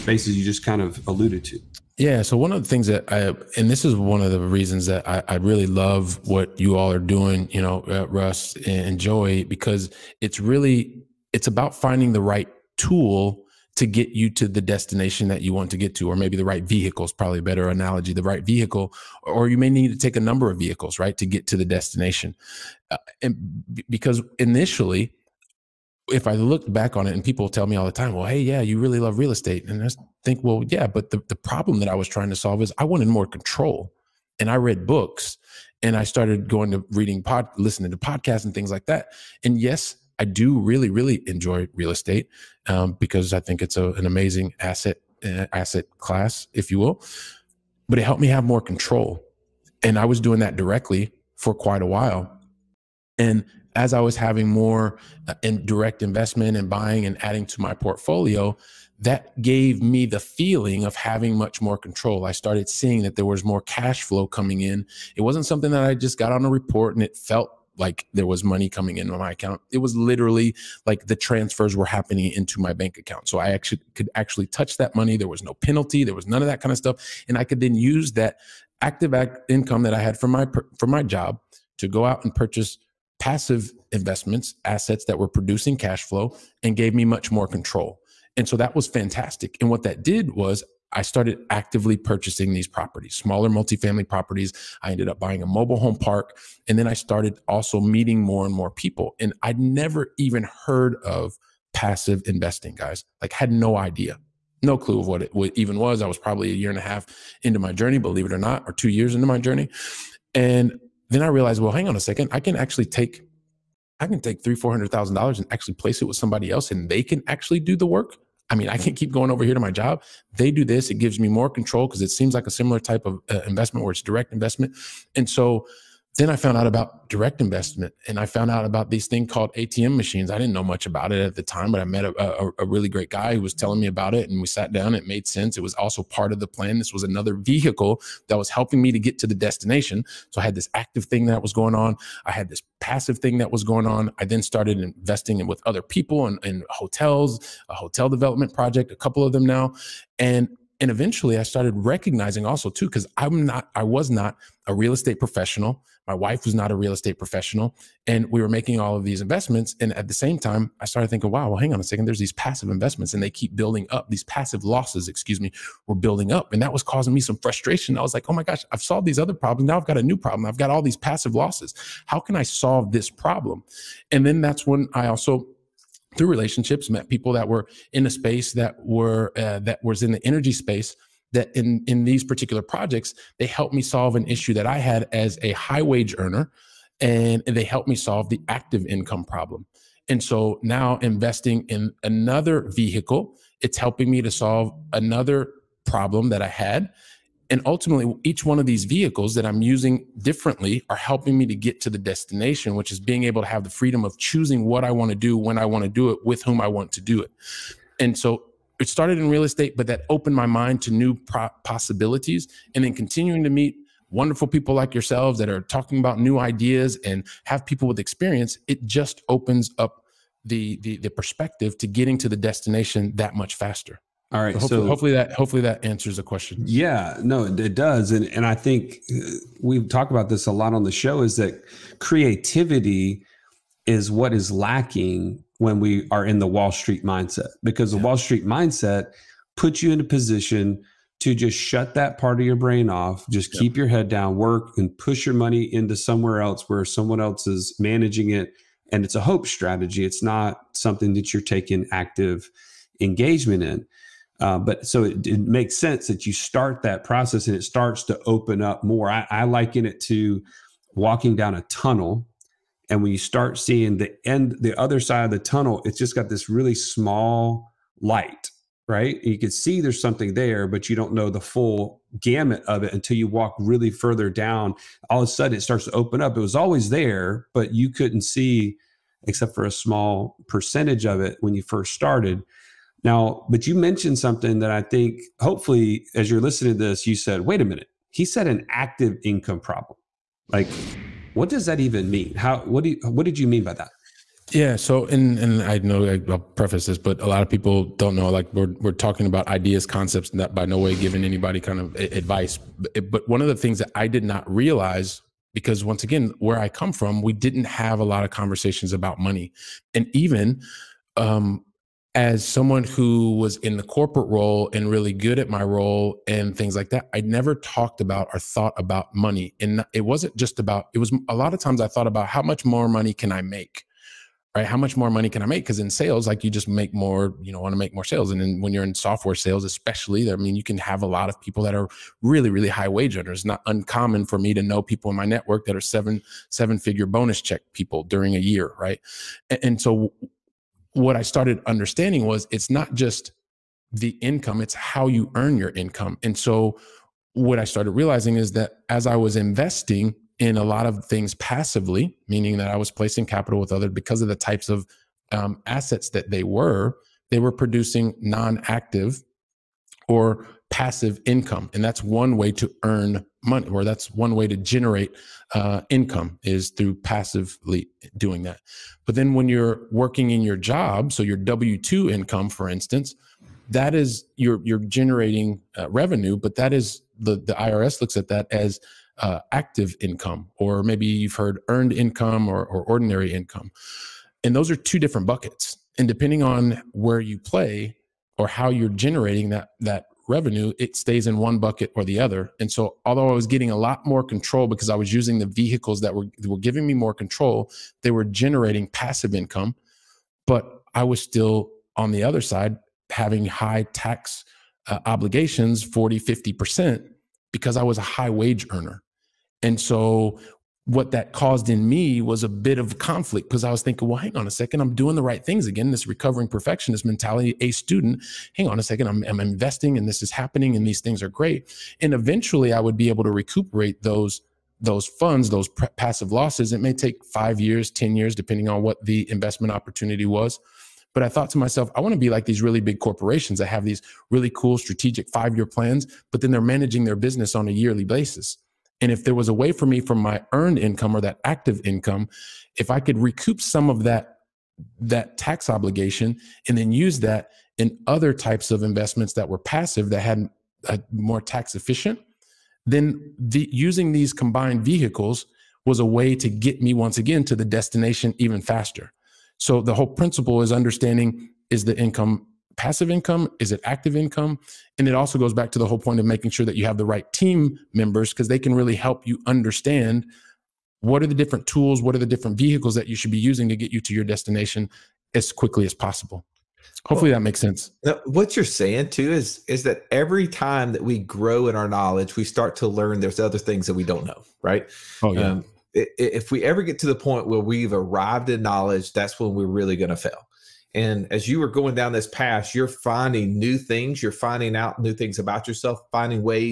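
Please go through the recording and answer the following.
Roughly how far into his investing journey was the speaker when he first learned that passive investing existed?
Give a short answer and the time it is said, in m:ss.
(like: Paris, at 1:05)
two years, at 1:48.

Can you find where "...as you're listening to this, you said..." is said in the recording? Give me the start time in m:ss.
4:46.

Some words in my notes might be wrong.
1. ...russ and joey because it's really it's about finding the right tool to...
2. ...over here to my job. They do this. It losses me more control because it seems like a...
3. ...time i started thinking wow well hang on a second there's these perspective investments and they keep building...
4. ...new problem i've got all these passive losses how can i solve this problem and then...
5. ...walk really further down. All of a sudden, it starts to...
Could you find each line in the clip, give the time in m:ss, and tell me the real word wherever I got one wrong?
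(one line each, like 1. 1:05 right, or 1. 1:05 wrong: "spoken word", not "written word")
1. 0:08 right
2. 1:59 wrong: "gives", not "losses"
3. 2:40 wrong: "passive", not "perspective"
4. 2:50 right
5. 4:33 right.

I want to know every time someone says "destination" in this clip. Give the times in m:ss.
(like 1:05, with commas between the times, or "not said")
0:14, 0:21, 2:19, 3:21, 3:42, 7:37, 7:54.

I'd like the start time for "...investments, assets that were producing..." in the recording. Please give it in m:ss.
1:23.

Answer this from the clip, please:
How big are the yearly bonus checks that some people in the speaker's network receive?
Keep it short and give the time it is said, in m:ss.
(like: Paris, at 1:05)
seven figure, at 5:36.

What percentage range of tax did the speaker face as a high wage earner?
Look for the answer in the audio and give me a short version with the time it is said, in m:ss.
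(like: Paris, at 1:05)
40 to 50%, at 6:45.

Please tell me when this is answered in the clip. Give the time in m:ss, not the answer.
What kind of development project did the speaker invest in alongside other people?
2:27.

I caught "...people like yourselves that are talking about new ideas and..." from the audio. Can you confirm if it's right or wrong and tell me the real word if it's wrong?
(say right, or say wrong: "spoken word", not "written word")
right.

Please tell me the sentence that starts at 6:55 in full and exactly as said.
This recovering perfectionist mentality, a student, hang on a second, I'm, I'm investing and this is happening and these things are great.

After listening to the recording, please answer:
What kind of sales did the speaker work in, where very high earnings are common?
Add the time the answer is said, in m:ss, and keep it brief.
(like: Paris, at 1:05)
software sales, at 5:28.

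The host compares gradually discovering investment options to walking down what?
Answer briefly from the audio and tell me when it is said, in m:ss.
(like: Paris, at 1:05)
a tunnel, at 4:21.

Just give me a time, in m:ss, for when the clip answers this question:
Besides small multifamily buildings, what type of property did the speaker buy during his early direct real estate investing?
1:35.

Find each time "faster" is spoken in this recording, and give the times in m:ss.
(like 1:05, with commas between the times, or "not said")
3:43, 7:38.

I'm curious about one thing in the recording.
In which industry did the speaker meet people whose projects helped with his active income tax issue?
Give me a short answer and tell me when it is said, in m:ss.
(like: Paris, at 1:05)
energy, at 3:00.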